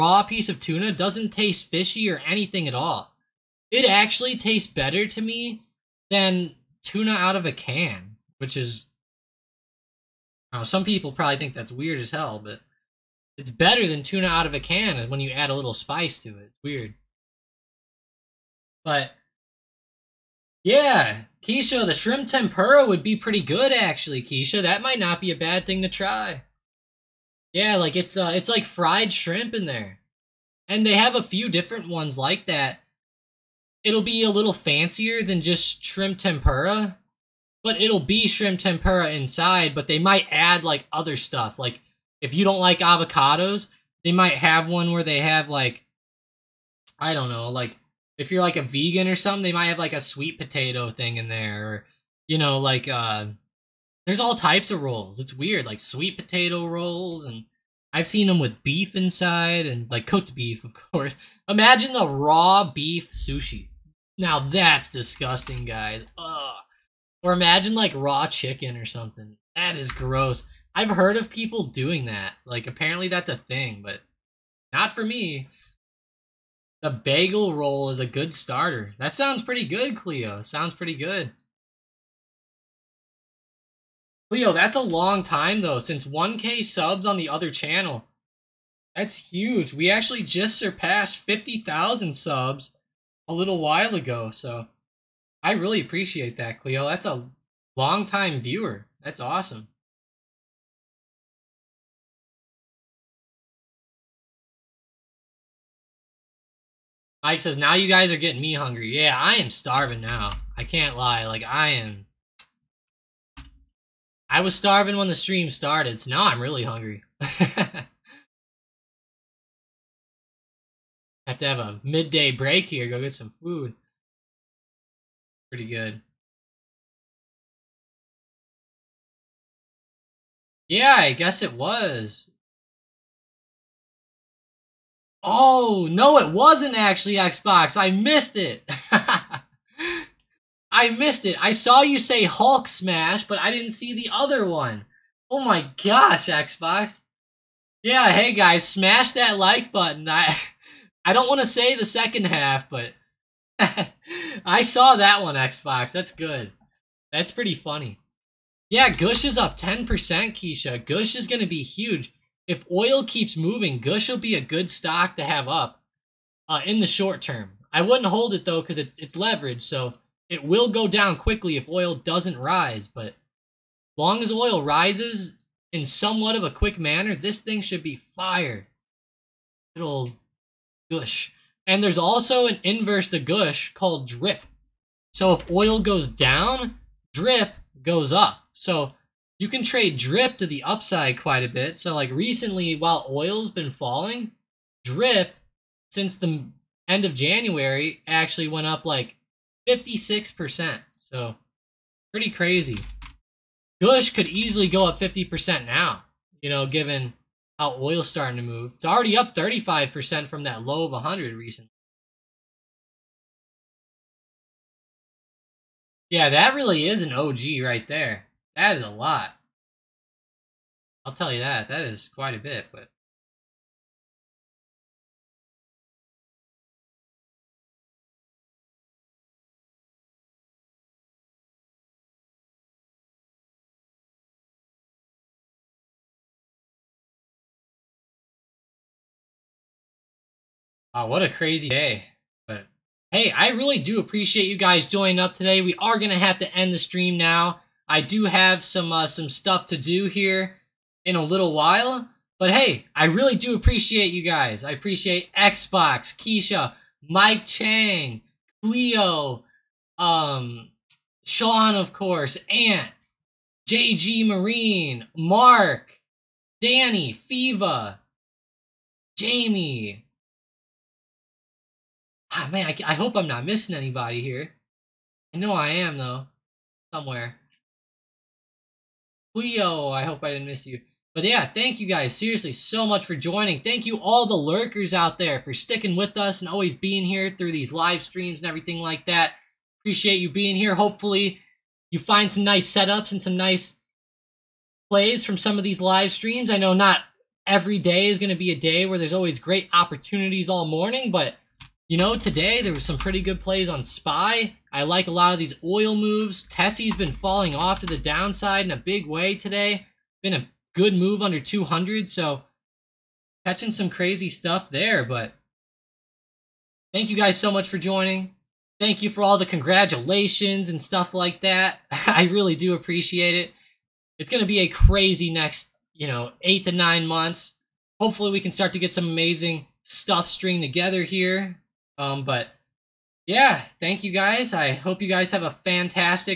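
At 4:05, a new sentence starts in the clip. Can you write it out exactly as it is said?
We are going to have to end the stream now.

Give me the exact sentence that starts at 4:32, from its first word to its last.
Ah, man, I, I hope I'm not missing anybody here.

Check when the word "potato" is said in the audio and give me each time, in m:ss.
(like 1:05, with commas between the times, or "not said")
0:50, 0:56.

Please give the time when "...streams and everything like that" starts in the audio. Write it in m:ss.
4:48.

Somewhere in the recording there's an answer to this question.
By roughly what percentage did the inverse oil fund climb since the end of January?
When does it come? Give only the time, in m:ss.
3:19.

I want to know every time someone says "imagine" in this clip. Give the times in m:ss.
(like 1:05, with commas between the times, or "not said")
1:01, 1:07.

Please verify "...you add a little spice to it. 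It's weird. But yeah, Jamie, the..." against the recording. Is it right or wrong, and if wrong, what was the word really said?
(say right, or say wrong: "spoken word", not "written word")
wrong: "Keisha", not "Jamie".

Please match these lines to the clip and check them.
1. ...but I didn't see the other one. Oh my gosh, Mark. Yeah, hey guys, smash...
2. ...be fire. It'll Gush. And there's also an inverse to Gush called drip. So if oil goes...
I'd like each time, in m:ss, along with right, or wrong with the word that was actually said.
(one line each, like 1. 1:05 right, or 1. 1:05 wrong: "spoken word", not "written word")
1. 2:23 wrong: "Xbox", not "Mark"
2. 2:57 right.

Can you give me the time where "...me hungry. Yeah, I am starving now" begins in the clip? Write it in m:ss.
1:48.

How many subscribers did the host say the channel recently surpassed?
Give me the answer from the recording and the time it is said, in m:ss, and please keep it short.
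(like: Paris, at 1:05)
50,000, at 1:31.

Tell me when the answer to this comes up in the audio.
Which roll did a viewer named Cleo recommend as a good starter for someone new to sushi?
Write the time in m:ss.
1:16.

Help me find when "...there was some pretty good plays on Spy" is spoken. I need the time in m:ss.
5:02.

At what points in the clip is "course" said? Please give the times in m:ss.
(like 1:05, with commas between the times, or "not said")
1:00, 4:21.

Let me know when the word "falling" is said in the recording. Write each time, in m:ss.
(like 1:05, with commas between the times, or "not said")
3:13, 5:07.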